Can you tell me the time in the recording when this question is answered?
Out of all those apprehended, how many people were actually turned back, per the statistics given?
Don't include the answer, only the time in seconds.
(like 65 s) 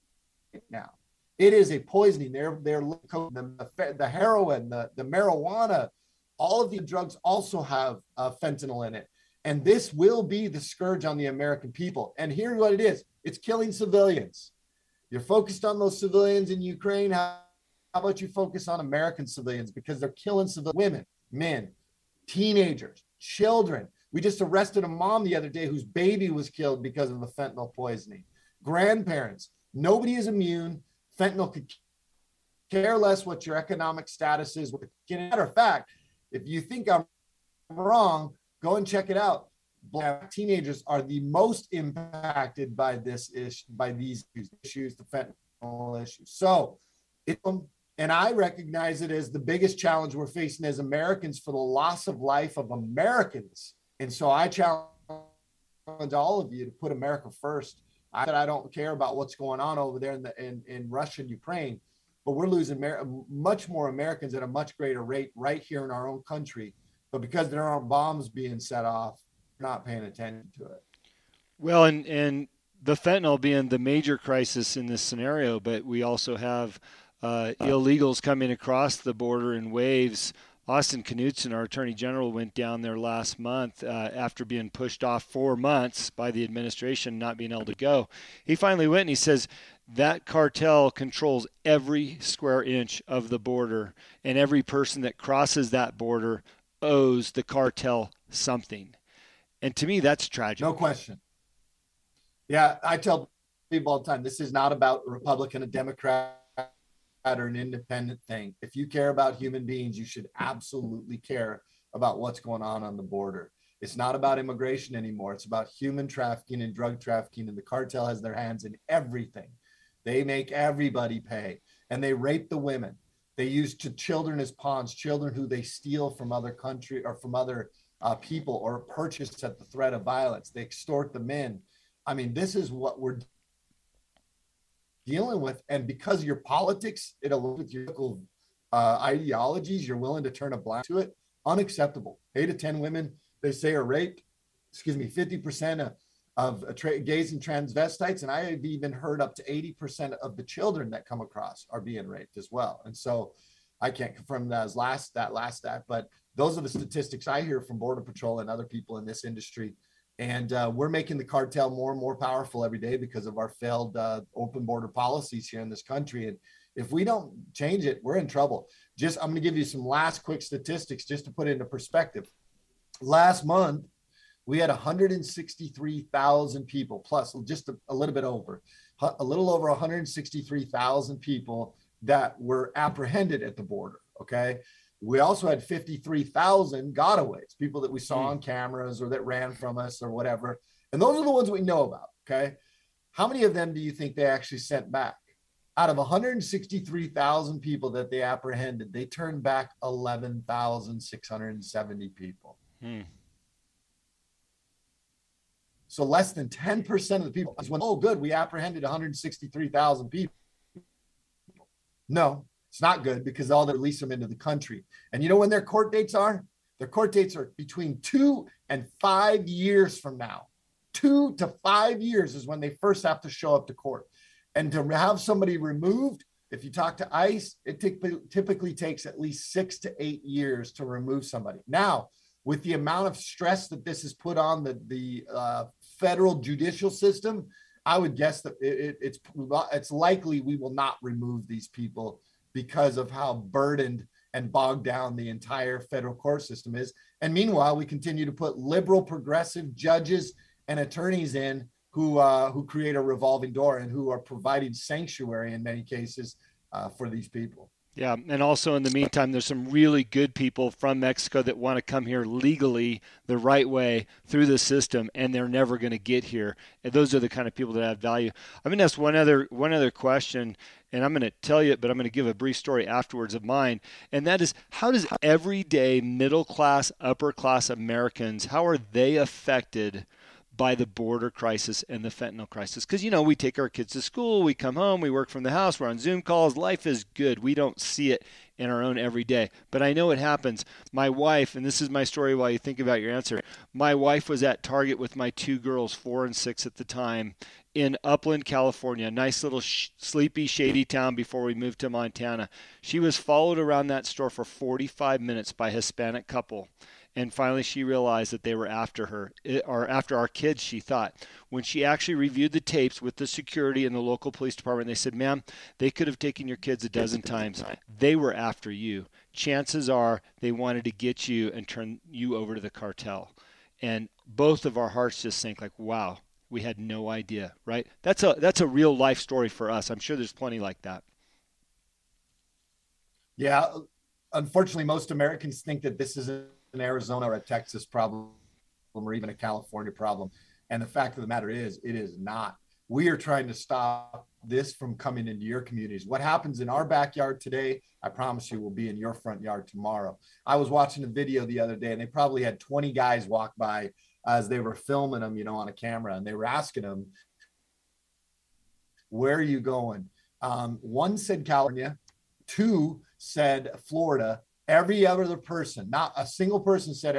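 199 s.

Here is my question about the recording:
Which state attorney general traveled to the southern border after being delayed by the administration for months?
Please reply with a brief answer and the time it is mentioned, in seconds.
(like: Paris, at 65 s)
Austin Knudsen, at 80 s.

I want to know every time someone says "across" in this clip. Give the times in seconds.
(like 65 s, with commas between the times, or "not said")
78 s, 151 s.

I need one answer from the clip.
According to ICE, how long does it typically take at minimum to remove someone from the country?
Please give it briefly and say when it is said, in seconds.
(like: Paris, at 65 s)
6 to 8 years, at 229 s.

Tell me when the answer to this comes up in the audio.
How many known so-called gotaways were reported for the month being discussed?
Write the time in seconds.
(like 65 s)
185 s.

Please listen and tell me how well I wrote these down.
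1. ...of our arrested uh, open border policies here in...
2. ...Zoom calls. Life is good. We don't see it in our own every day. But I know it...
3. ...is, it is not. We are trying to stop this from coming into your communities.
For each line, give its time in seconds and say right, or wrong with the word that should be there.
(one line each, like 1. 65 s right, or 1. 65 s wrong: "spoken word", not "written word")
1. 163 s wrong: "failed", not "arrested"
2. 285 s right
3. 341 s right.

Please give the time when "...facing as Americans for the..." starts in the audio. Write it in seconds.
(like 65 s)
50 s.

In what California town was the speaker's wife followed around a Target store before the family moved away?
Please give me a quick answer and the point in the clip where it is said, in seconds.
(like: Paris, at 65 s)
Upland, at 298 s.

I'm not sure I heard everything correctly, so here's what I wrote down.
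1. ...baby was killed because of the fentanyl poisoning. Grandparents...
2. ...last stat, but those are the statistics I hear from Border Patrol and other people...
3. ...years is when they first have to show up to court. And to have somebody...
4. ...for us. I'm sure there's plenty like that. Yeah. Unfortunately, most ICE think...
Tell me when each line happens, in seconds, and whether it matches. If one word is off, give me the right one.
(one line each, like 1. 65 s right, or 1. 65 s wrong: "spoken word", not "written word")
1. 25 s right
2. 155 s right
3. 221 s right
4. 329 s wrong: "Americans", not "ICE".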